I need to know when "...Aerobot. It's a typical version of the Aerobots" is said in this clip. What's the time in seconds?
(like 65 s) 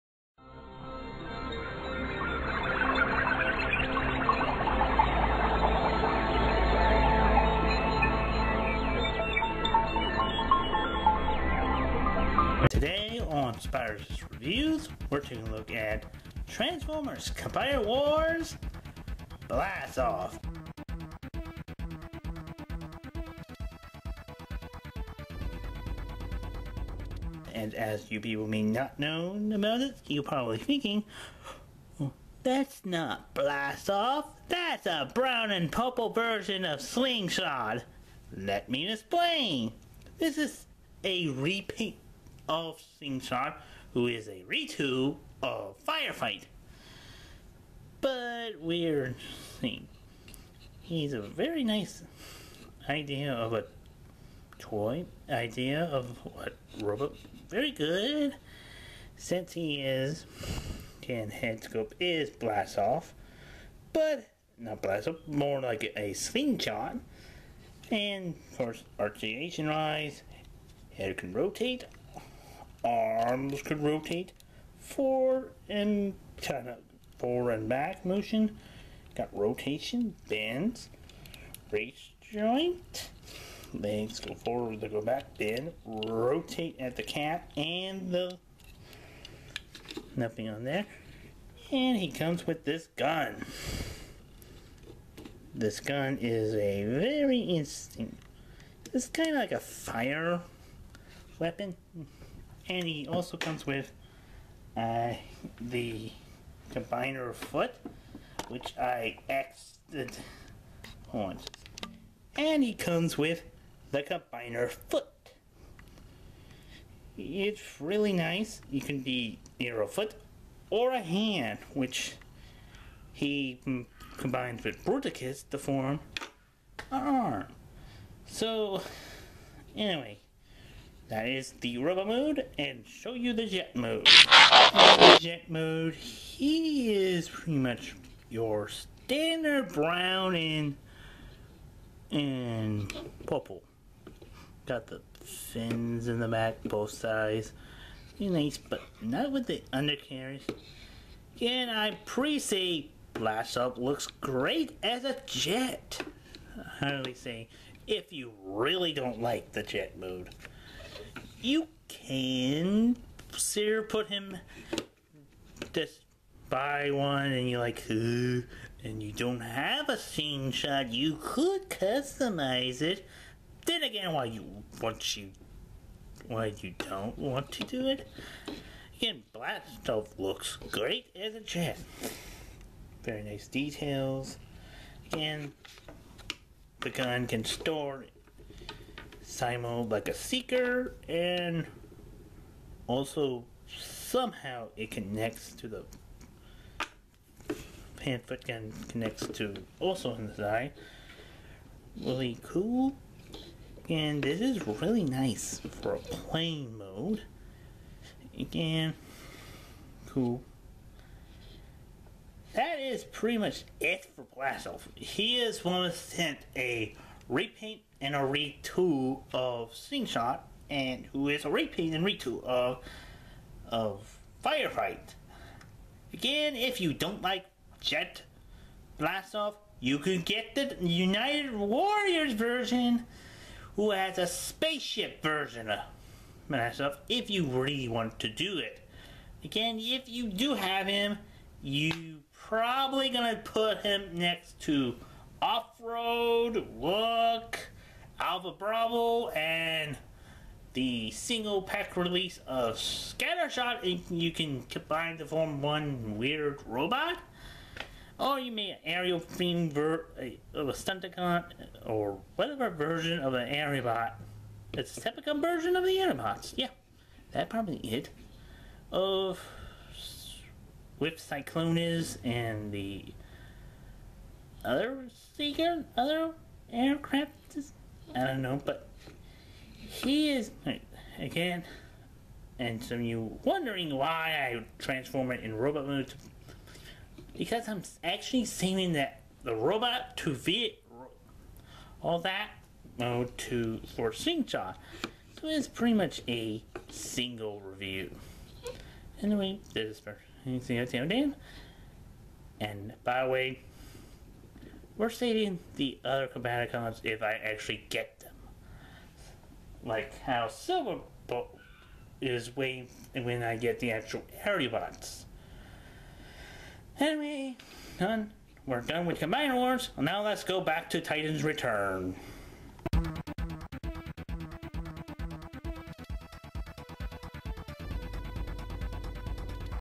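263 s.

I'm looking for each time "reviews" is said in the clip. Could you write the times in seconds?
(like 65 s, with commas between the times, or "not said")
14 s, 297 s.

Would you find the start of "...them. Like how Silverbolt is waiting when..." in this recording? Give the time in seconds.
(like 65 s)
308 s.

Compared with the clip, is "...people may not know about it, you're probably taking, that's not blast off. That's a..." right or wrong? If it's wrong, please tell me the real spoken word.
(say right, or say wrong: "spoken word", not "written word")
wrong: "thinking", not "taking".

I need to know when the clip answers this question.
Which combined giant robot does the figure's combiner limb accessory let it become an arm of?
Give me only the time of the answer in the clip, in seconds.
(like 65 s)
124 s.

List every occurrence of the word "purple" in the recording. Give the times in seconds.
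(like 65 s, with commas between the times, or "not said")
35 s, 143 s.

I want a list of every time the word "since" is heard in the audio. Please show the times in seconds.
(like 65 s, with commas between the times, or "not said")
59 s.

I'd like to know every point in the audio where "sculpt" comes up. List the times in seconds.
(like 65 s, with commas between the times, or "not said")
not said.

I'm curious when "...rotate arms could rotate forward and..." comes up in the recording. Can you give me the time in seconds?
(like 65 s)
71 s.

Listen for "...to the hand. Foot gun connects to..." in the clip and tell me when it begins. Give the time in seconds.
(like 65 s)
195 s.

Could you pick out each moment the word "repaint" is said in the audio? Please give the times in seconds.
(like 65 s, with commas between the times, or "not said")
41 s, 217 s, 221 s.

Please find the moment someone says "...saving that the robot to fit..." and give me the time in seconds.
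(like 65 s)
288 s.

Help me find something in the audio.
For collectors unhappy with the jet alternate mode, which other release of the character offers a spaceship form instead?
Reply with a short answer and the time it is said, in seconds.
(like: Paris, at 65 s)
United Warriors, at 230 s.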